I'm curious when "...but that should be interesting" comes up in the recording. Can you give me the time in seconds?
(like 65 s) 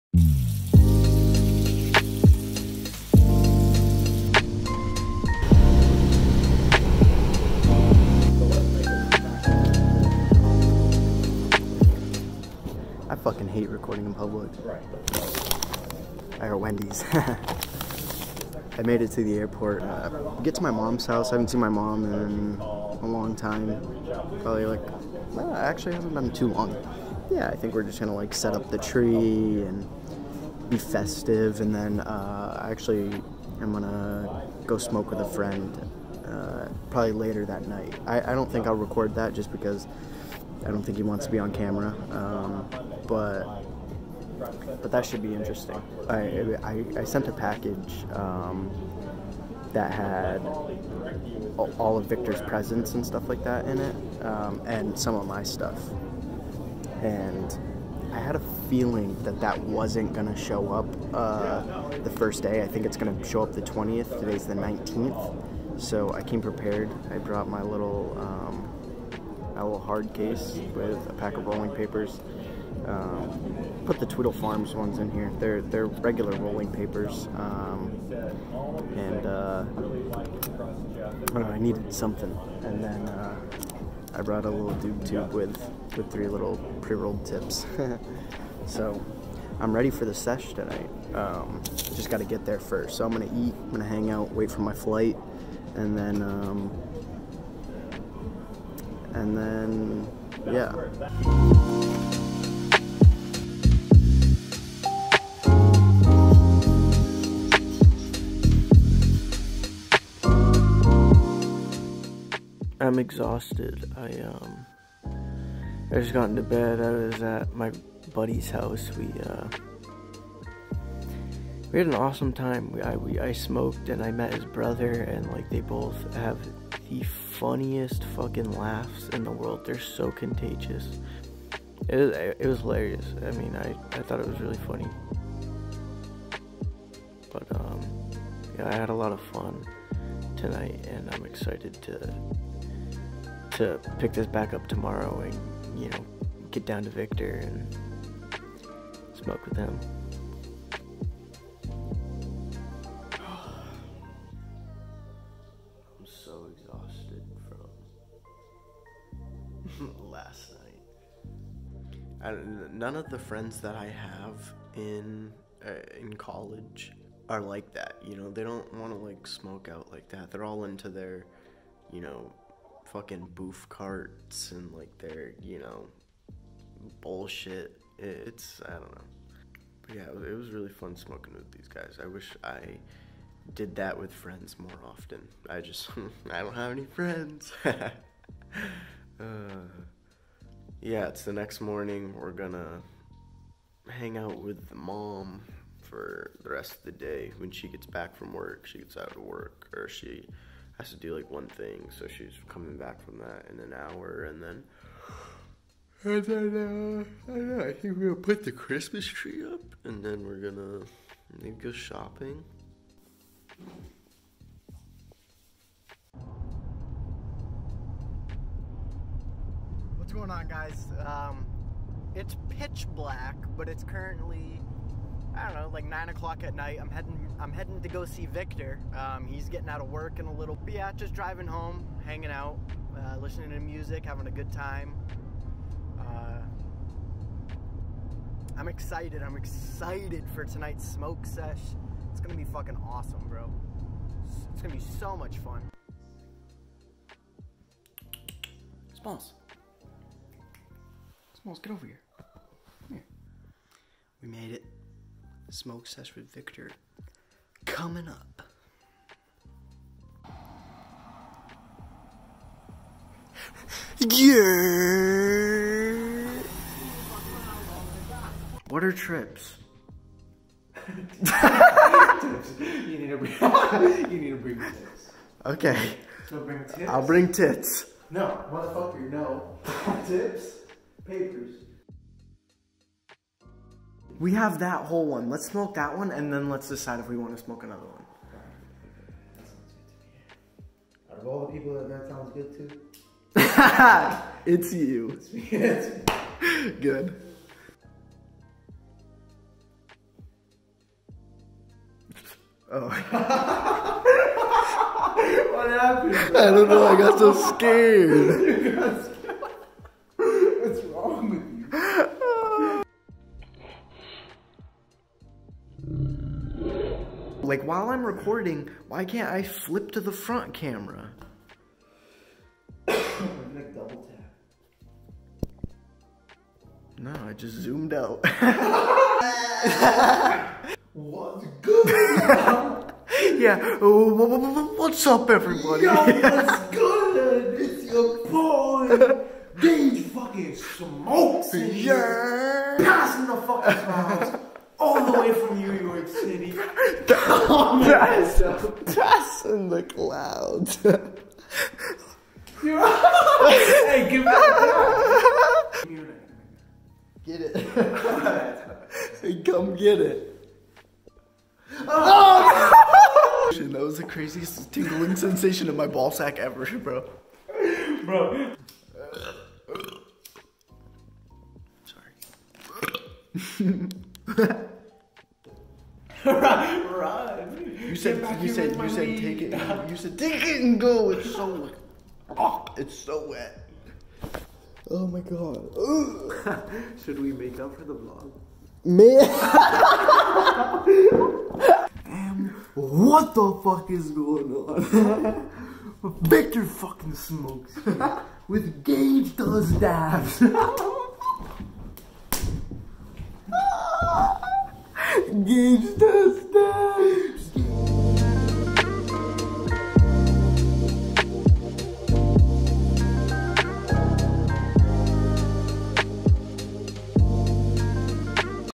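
44 s.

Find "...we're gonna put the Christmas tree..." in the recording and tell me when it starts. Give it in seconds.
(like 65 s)
207 s.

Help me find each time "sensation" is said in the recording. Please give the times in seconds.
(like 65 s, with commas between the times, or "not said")
365 s.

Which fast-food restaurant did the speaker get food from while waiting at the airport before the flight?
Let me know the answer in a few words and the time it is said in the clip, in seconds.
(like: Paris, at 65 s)
Wendy's, at 16 s.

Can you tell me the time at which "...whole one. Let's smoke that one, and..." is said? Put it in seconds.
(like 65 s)
284 s.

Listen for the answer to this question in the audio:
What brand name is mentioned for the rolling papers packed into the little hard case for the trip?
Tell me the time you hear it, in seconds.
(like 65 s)
74 s.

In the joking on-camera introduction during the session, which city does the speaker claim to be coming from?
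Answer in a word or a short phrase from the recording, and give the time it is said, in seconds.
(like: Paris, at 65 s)
New York City, at 345 s.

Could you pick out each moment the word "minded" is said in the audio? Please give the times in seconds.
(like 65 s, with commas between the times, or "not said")
not said.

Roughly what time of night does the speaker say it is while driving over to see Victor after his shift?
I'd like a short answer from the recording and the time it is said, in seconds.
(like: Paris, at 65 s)
9 o'clock, at 225 s.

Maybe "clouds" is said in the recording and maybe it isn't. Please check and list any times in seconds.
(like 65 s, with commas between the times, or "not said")
343 s, 349 s.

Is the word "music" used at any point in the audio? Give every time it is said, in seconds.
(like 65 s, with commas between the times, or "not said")
233 s.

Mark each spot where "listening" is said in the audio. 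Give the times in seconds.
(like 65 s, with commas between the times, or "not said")
233 s.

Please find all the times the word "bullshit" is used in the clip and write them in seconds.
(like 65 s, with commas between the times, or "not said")
177 s.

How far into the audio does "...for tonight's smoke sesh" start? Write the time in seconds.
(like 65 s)
240 s.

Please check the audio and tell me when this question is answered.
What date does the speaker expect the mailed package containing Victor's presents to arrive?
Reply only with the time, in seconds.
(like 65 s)
63 s.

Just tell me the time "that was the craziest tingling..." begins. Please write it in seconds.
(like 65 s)
363 s.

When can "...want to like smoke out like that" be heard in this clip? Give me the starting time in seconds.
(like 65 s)
168 s.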